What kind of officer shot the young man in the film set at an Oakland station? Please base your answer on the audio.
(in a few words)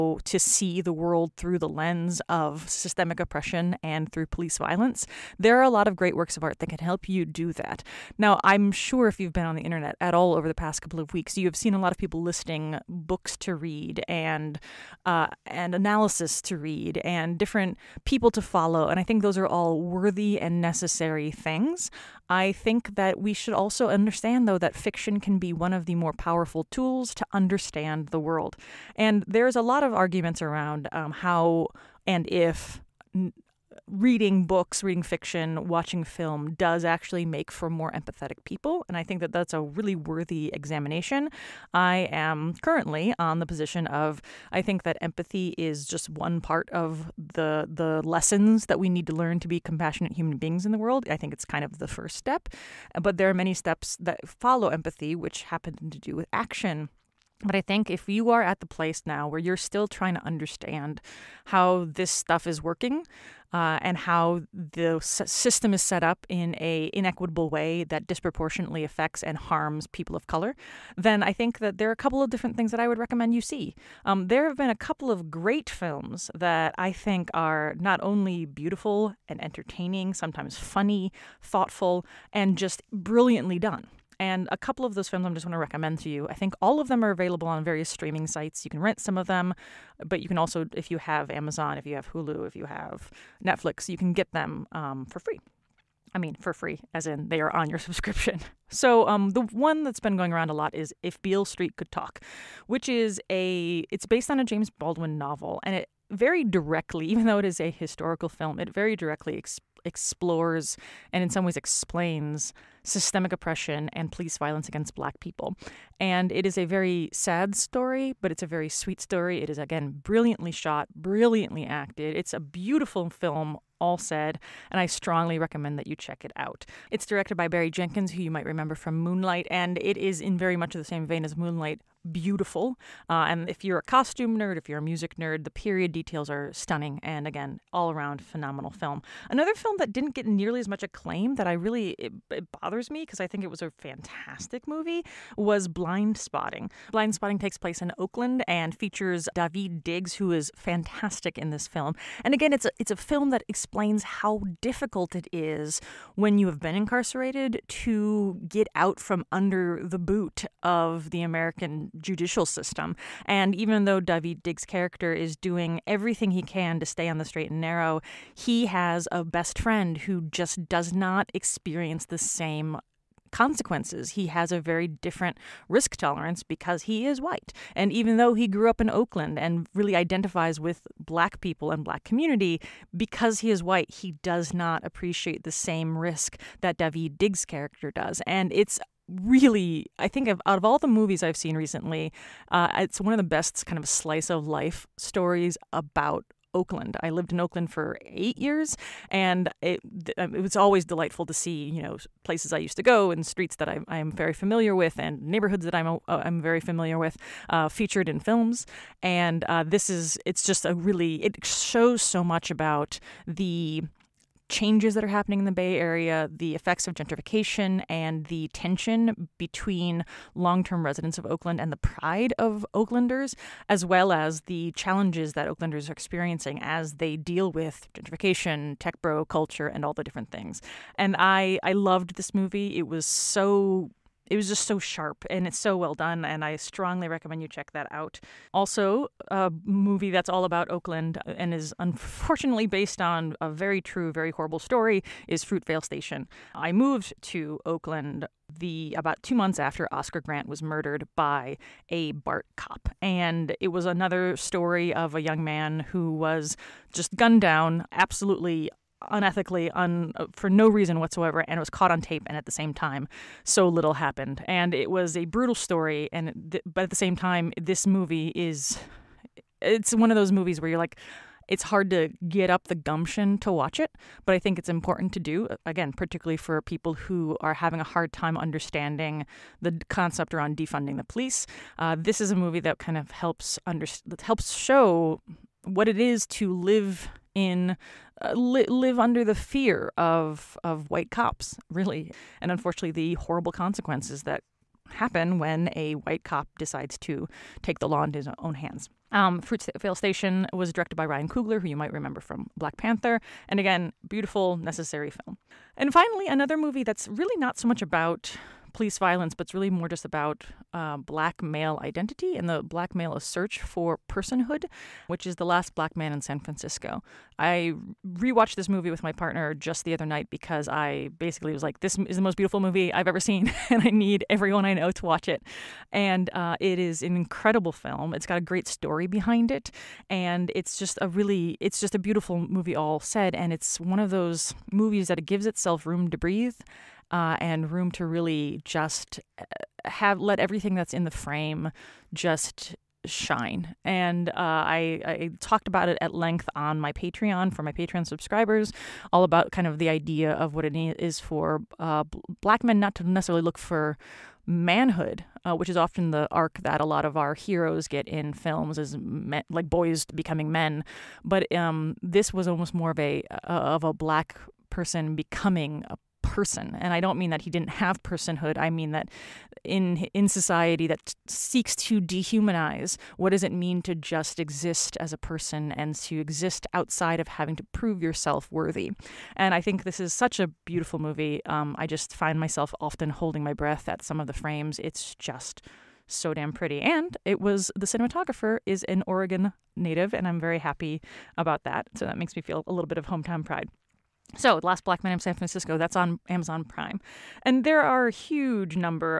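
BART cop.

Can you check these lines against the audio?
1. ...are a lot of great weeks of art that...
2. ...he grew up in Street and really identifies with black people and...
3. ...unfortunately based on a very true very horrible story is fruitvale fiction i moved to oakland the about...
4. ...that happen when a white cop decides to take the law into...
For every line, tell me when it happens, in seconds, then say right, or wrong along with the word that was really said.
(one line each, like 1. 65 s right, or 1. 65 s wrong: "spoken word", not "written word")
1. 5 s wrong: "works", not "weeks"
2. 178 s wrong: "Oakland", not "Street"
3. 241 s wrong: "station", not "fiction"
4. 294 s right.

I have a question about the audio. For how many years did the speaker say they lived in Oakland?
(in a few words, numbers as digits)
8.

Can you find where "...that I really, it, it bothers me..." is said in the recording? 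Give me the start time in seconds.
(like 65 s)
141 s.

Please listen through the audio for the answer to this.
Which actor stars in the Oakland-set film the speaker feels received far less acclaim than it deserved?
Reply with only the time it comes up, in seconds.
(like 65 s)
149 s.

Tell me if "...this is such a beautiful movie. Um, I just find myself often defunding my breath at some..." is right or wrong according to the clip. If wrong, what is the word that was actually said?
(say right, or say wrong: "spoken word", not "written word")
wrong: "holding", not "defunding".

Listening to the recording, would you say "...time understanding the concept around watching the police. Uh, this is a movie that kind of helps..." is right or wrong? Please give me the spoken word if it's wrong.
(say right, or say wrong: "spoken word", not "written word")
wrong: "defunding", not "watching".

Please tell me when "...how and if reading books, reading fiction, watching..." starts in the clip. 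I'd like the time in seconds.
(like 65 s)
31 s.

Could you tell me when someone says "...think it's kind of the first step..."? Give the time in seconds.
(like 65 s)
51 s.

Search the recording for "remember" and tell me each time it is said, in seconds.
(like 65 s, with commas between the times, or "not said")
128 s, 301 s.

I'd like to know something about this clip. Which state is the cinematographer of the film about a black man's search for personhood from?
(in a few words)
Oregon.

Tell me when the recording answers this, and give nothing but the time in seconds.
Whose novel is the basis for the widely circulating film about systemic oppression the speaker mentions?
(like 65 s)
104 s.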